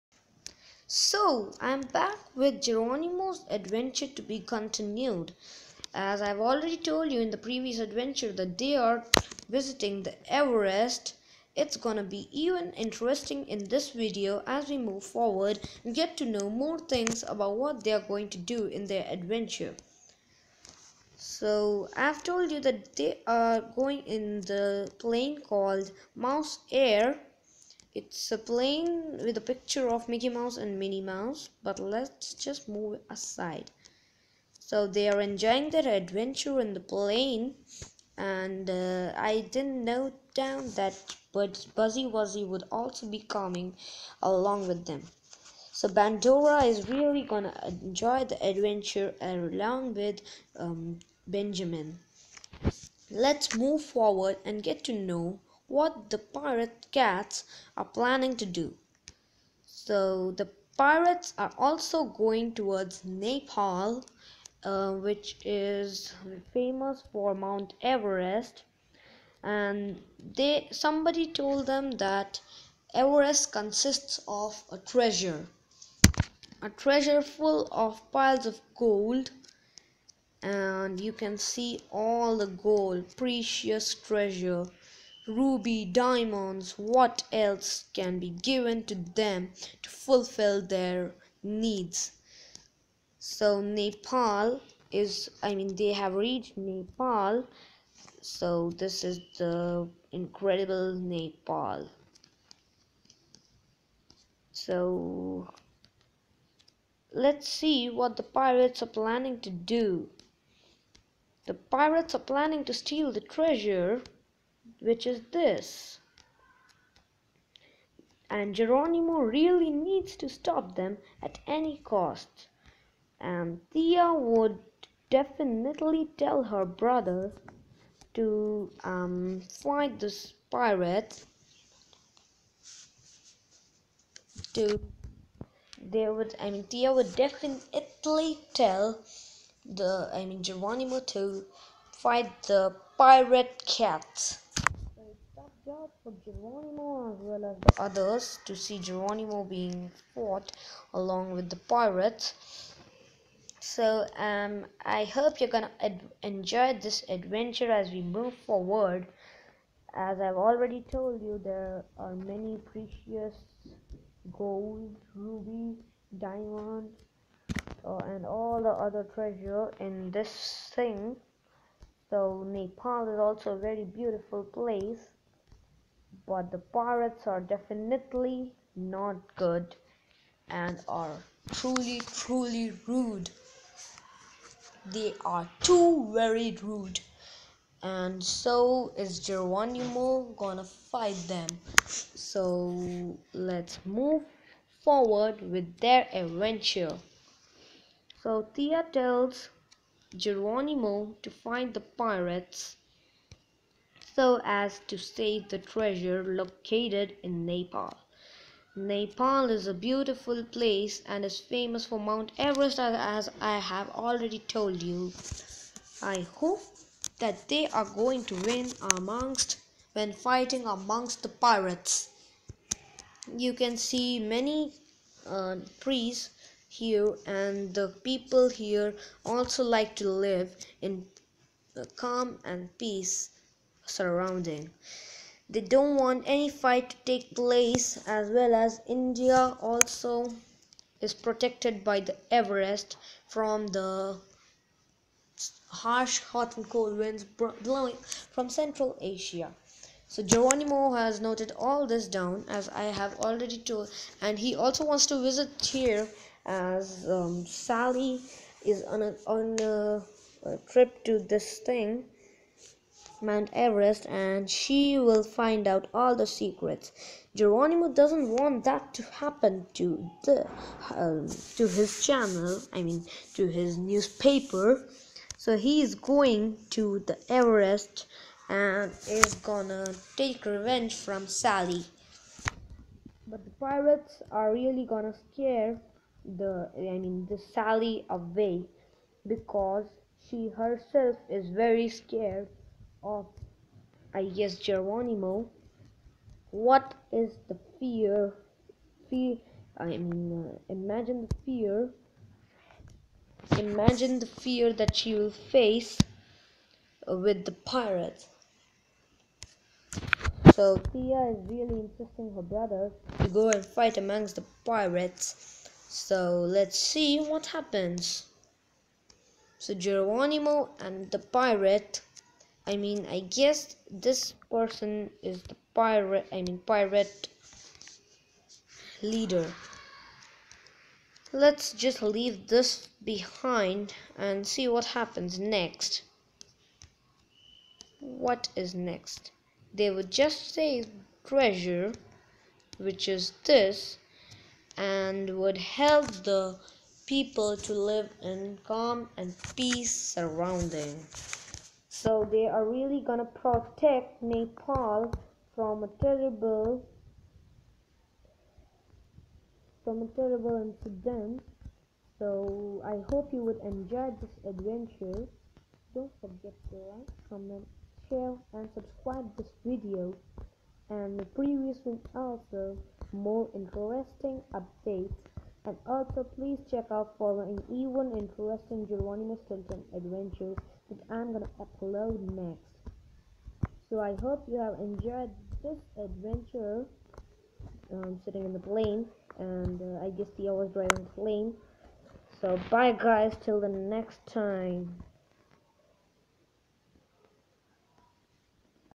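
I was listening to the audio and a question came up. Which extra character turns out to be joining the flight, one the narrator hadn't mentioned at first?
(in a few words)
Buzz Bugsy Wugsy.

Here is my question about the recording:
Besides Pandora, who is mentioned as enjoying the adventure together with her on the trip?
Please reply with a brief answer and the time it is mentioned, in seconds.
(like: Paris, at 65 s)
Benjamin, at 51 s.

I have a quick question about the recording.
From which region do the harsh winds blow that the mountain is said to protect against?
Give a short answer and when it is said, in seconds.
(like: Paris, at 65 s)
Central Asia, at 248 s.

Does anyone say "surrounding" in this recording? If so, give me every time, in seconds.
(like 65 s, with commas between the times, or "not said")
233 s, 349 s.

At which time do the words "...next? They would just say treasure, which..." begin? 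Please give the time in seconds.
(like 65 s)
338 s.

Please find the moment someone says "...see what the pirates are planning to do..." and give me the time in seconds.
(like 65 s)
107 s.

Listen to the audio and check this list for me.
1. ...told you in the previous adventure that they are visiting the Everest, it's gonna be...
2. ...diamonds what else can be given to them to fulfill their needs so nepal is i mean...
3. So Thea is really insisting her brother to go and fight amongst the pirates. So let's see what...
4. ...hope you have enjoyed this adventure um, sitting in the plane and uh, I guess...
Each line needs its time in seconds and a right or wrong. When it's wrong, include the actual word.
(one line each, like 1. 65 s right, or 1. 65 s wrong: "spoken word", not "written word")
1. 6 s right
2. 85 s right
3. 310 s right
4. 384 s right.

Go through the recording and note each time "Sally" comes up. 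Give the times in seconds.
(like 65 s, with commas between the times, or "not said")
257 s, 281 s, 287 s.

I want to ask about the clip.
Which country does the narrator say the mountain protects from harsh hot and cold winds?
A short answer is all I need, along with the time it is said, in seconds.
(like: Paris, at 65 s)
India, at 238 s.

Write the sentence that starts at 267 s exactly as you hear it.
Geronimo doesn't want that to happen to the um, to his channel, I mean to his newspaper.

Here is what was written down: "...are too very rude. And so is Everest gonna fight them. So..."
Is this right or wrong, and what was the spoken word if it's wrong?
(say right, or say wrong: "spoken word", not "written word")
wrong: "Geronimo", not "Everest".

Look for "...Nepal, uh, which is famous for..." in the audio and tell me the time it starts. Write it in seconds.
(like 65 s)
63 s.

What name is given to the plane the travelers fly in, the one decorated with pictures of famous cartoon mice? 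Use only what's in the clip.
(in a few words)
Mouse Air.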